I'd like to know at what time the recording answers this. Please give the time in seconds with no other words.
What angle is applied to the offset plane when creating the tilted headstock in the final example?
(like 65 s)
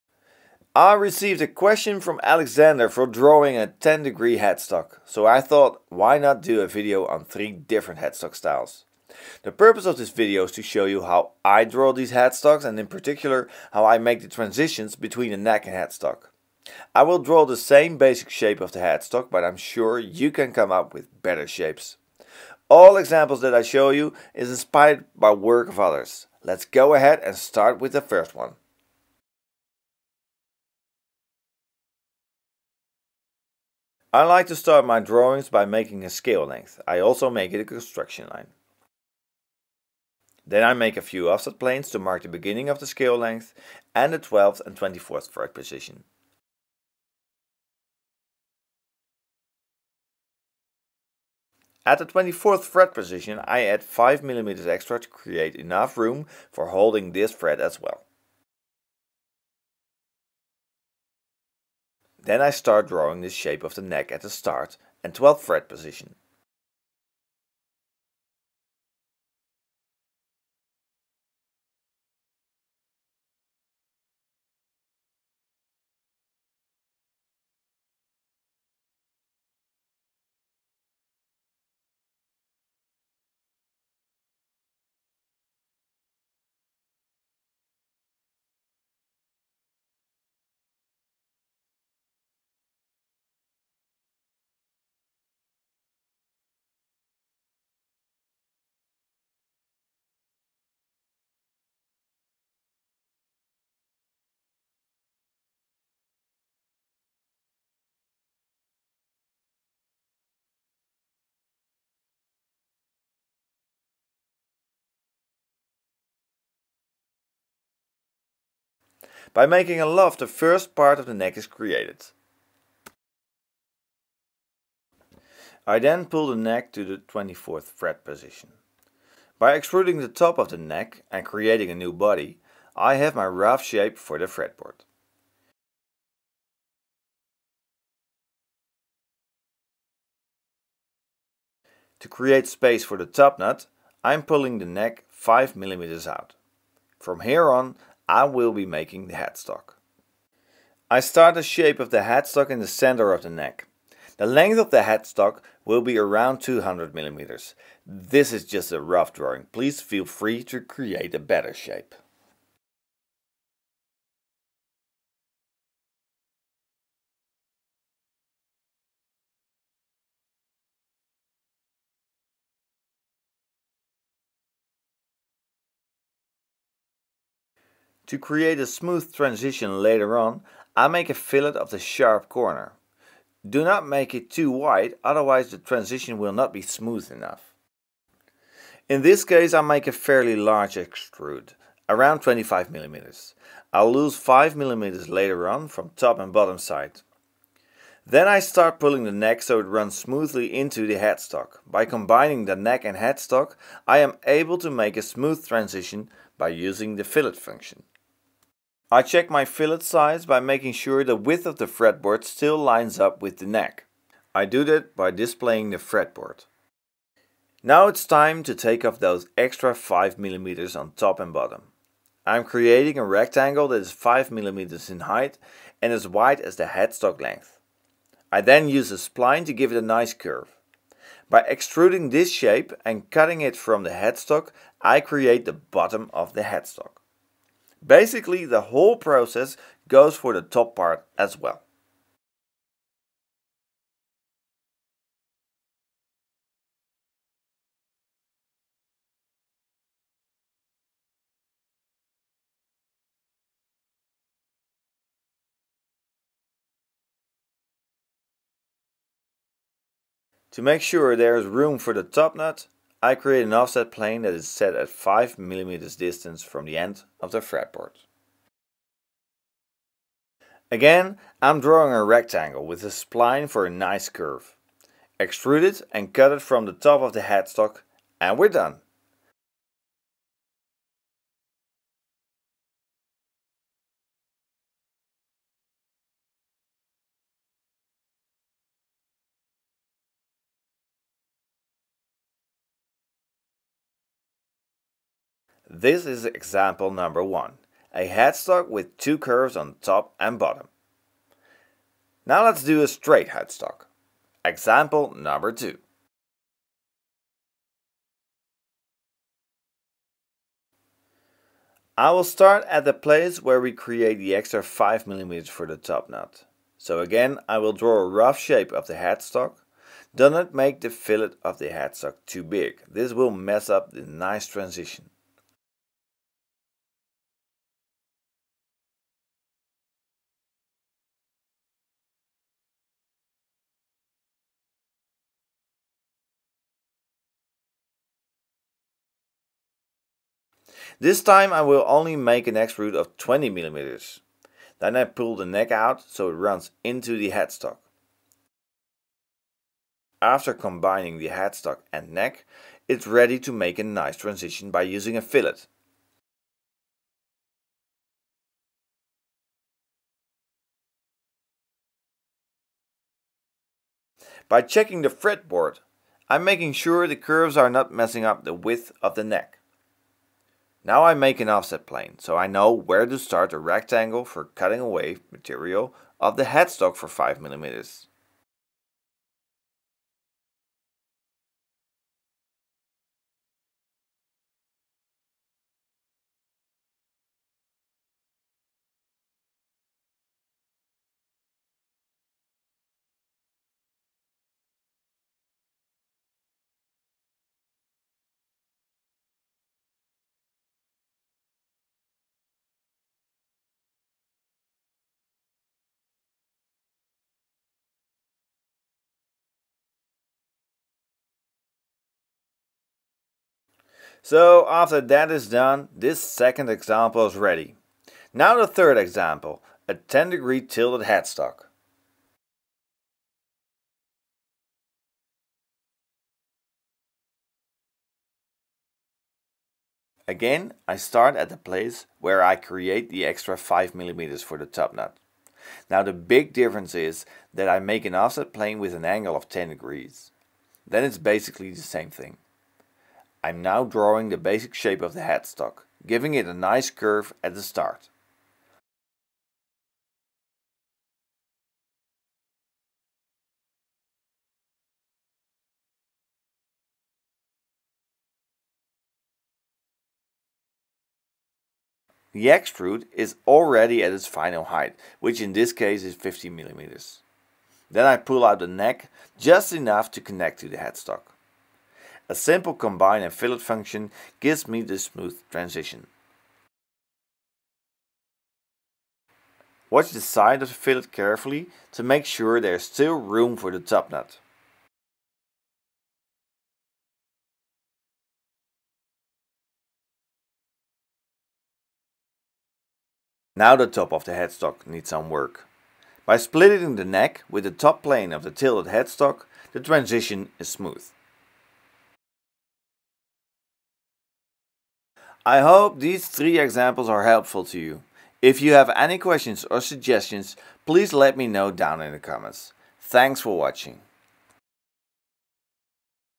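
439 s.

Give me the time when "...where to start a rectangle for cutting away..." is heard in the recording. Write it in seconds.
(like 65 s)
372 s.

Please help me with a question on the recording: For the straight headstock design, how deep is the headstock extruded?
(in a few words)
20 millimeters.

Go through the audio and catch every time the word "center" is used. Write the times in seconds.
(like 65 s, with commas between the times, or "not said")
152 s.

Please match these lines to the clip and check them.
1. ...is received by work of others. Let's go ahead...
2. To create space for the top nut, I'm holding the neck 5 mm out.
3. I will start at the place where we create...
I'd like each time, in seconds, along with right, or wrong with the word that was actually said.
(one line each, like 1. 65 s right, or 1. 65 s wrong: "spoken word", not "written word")
1. 24 s wrong: "inspired", not "received"
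2. 141 s wrong: "pulling", not "holding"
3. 311 s right.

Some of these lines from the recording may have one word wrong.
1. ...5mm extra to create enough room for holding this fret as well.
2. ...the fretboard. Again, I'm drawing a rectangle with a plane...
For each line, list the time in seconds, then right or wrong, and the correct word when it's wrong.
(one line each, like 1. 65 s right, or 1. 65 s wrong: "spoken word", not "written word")
1. 53 s right
2. 267 s wrong: "spline", not "plane".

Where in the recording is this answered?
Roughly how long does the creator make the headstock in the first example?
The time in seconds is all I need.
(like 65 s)
156 s.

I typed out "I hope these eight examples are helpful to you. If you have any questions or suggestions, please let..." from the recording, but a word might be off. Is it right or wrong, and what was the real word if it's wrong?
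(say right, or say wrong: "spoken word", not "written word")
wrong: "three", not "eight".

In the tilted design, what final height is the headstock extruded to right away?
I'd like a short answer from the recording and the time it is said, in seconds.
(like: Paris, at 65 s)
50 millimeters, at 466 s.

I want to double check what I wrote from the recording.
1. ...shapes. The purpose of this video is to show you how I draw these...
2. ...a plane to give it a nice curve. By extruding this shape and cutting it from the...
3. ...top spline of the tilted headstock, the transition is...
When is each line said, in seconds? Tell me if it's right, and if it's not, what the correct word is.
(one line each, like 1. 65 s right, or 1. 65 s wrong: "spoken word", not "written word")
1. 8 s wrong: "styles", not "shapes"
2. 228 s wrong: "spline", not "plane"
3. 497 s wrong: "plane", not "spline".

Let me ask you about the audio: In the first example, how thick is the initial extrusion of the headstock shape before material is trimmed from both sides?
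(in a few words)
25 mm.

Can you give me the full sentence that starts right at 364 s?
By checking the fretboard, I'm making sure the curves are not messing up the width of the neck.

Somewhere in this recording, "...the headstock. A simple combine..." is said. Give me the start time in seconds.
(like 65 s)
470 s.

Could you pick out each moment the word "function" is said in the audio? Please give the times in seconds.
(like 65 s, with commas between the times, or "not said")
207 s, 473 s.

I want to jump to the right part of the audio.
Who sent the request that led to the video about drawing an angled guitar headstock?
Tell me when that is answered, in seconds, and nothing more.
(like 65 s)
2 s.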